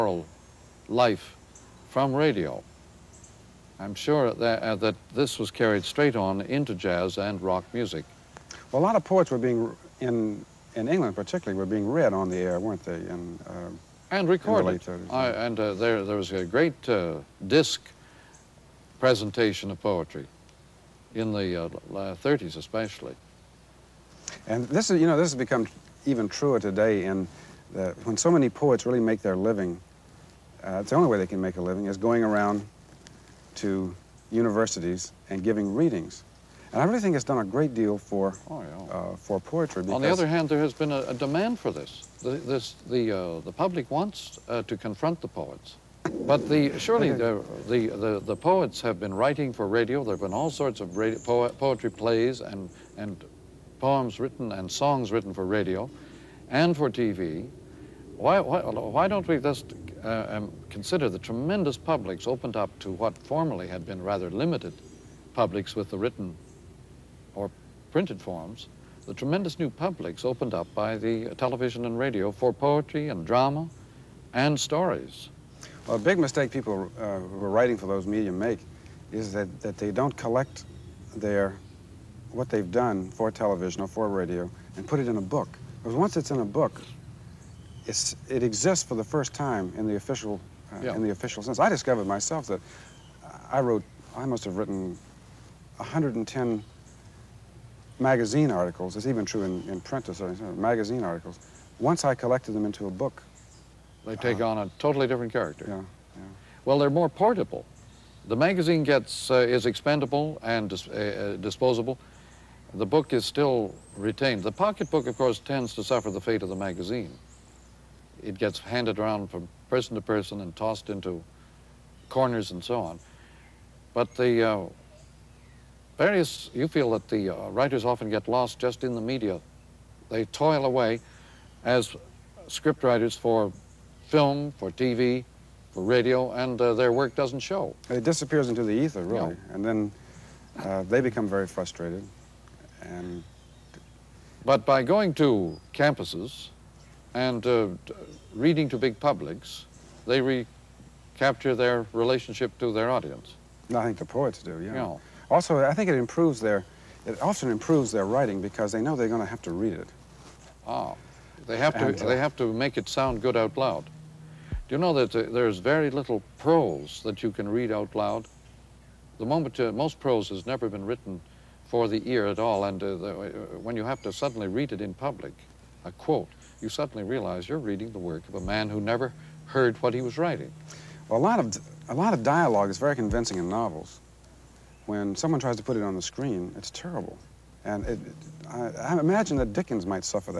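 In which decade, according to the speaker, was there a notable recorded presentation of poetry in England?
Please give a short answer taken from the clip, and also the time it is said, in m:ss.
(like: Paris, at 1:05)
1930s, at 0:21.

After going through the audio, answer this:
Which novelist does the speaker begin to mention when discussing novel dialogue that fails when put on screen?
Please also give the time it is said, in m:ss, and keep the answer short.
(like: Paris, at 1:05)
Dickens, at 3:09.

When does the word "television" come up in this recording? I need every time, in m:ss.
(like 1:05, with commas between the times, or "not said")
1:11, 1:23.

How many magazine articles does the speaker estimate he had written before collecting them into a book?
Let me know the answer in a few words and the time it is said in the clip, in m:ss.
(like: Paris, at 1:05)
110, at 1:35.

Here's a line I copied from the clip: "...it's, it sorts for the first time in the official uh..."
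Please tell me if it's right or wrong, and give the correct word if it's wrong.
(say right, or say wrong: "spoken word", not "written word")
wrong: "exists", not "sorts".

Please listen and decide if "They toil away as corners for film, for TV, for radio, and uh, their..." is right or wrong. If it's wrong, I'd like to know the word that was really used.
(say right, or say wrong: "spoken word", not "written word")
wrong: "scriptwriters", not "corners".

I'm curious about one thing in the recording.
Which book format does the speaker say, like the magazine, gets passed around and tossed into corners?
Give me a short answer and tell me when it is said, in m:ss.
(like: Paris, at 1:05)
pocketbook, at 1:54.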